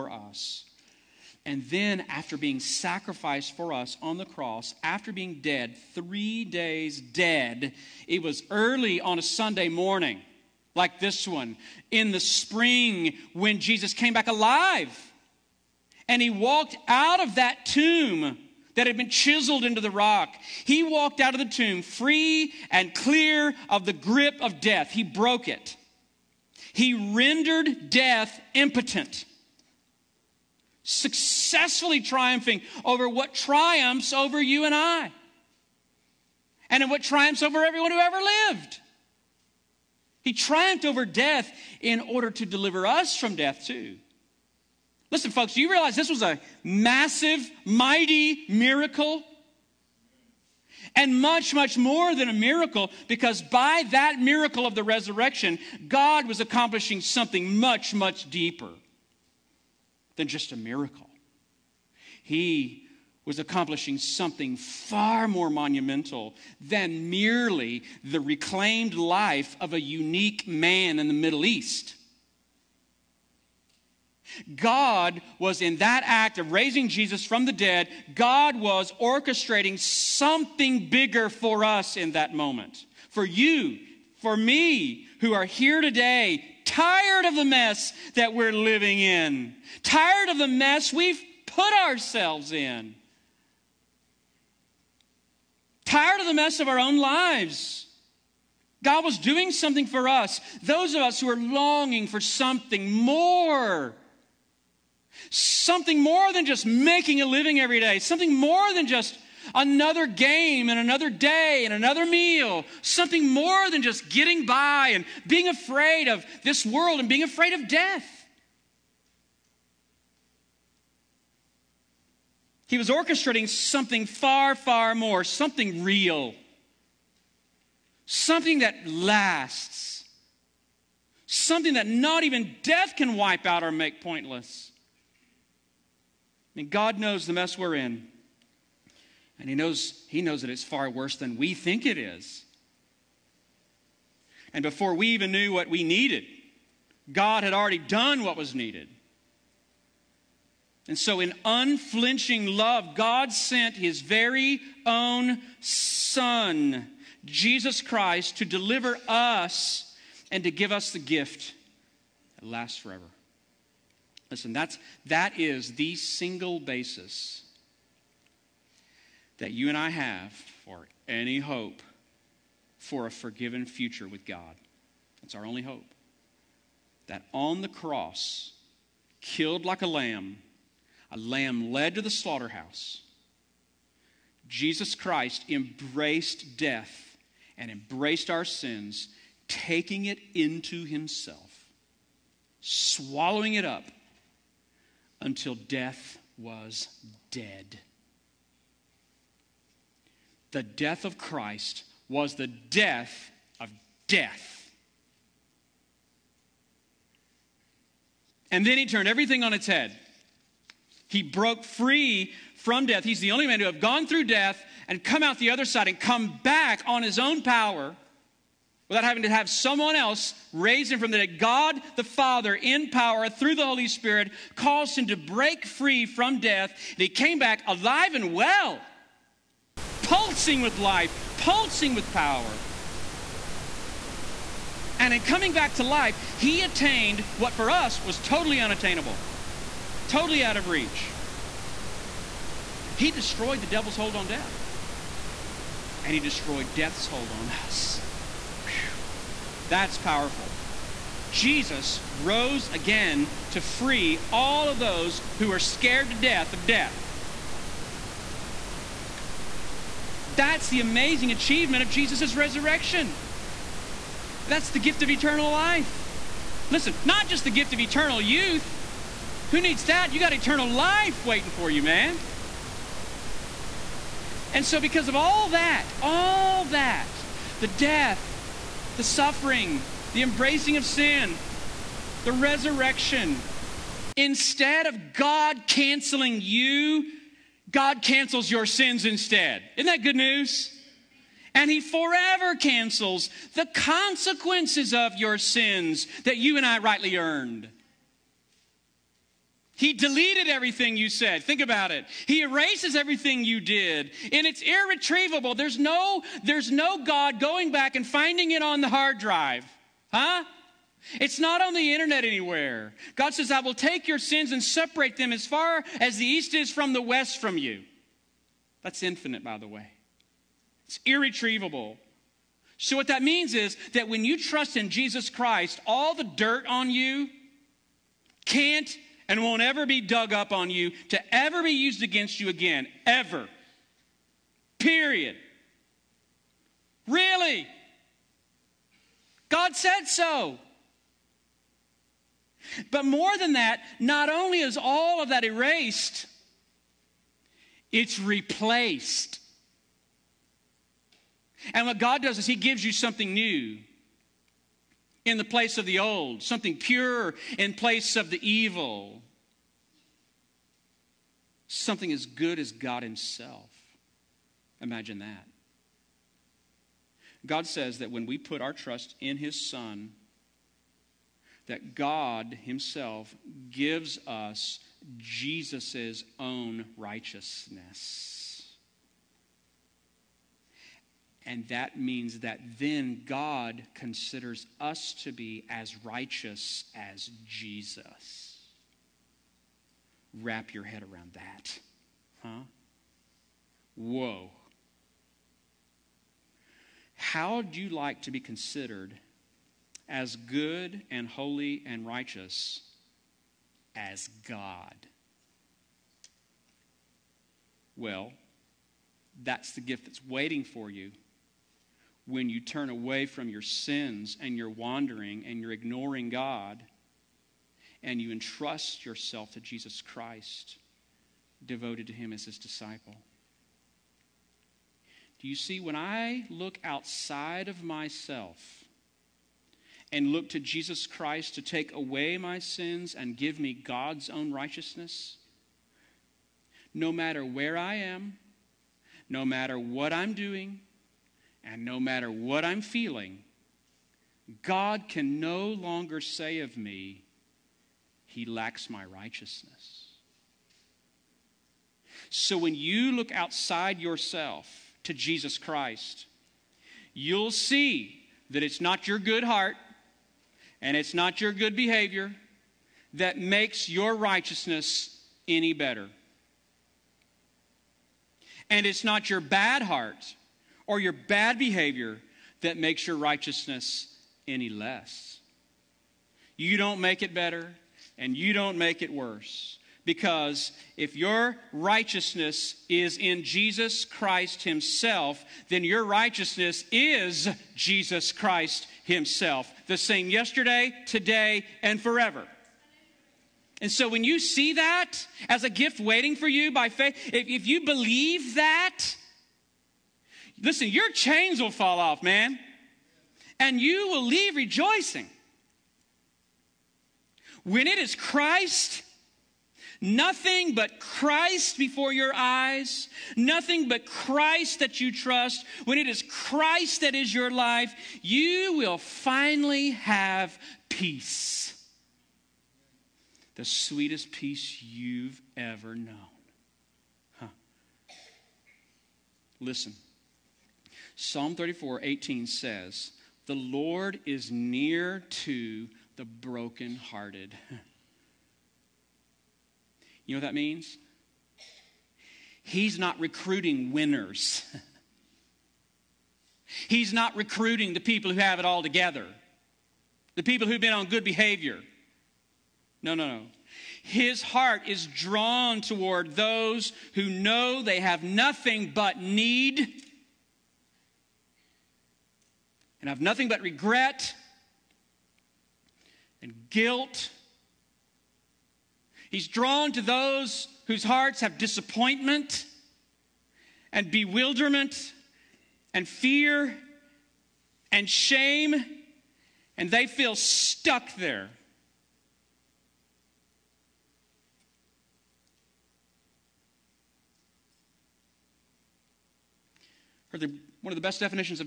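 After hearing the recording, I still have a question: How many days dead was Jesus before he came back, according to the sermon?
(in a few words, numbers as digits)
3.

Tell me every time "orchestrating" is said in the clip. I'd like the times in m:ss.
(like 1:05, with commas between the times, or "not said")
1:18, 2:02.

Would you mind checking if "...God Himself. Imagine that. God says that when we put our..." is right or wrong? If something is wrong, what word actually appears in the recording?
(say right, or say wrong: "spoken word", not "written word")
right.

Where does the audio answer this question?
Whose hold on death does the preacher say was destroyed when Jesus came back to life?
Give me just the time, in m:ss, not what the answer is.
4:03.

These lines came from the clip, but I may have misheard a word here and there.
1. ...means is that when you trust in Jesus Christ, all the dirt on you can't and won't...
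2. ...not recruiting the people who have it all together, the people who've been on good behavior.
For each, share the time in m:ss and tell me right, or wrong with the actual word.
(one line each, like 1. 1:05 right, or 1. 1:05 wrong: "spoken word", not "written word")
1. 5:23 right
2. 9:07 right.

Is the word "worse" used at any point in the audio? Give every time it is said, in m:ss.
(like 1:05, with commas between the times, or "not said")
2:20, 7:59.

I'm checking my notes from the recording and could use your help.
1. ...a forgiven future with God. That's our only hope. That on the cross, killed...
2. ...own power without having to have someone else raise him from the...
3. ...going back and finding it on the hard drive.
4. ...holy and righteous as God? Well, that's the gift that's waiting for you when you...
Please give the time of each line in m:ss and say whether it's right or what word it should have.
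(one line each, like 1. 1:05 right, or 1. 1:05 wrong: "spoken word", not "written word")
1. 2:53 right
2. 3:37 right
3. 5:07 right
4. 6:41 right.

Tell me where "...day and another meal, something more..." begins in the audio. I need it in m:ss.
1:51.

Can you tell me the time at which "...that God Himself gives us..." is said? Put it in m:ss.
6:11.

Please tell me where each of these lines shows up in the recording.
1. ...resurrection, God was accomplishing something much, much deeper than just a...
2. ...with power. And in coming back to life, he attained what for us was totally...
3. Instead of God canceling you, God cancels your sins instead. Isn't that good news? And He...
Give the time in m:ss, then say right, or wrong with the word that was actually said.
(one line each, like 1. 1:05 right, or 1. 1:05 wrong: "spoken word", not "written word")
1. 0:54 right
2. 3:51 right
3. 4:44 right.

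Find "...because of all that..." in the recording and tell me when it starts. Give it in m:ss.
4:34.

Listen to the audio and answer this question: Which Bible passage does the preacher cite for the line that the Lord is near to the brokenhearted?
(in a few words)
Psalm 34:18.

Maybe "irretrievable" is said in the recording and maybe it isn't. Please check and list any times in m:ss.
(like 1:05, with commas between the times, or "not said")
5:04, 5:21.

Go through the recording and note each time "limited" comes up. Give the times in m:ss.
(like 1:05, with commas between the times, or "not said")
not said.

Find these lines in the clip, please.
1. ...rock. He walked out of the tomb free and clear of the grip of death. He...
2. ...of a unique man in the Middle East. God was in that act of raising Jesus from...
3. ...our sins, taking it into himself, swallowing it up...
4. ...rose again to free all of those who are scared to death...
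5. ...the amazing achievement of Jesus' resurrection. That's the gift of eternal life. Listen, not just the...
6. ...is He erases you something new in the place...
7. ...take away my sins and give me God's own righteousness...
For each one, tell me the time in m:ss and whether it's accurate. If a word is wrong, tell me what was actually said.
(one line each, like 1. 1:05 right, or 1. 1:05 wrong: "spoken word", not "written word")
1. 0:19 right
2. 1:09 right
3. 3:08 right
4. 4:12 right
5. 4:20 right
6. 5:52 wrong: "gives", not "erases"
7. 7:11 right.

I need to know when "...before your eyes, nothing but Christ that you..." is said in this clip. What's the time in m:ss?
8:31.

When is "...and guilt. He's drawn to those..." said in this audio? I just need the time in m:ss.
9:26.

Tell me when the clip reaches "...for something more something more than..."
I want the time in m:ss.
1:42.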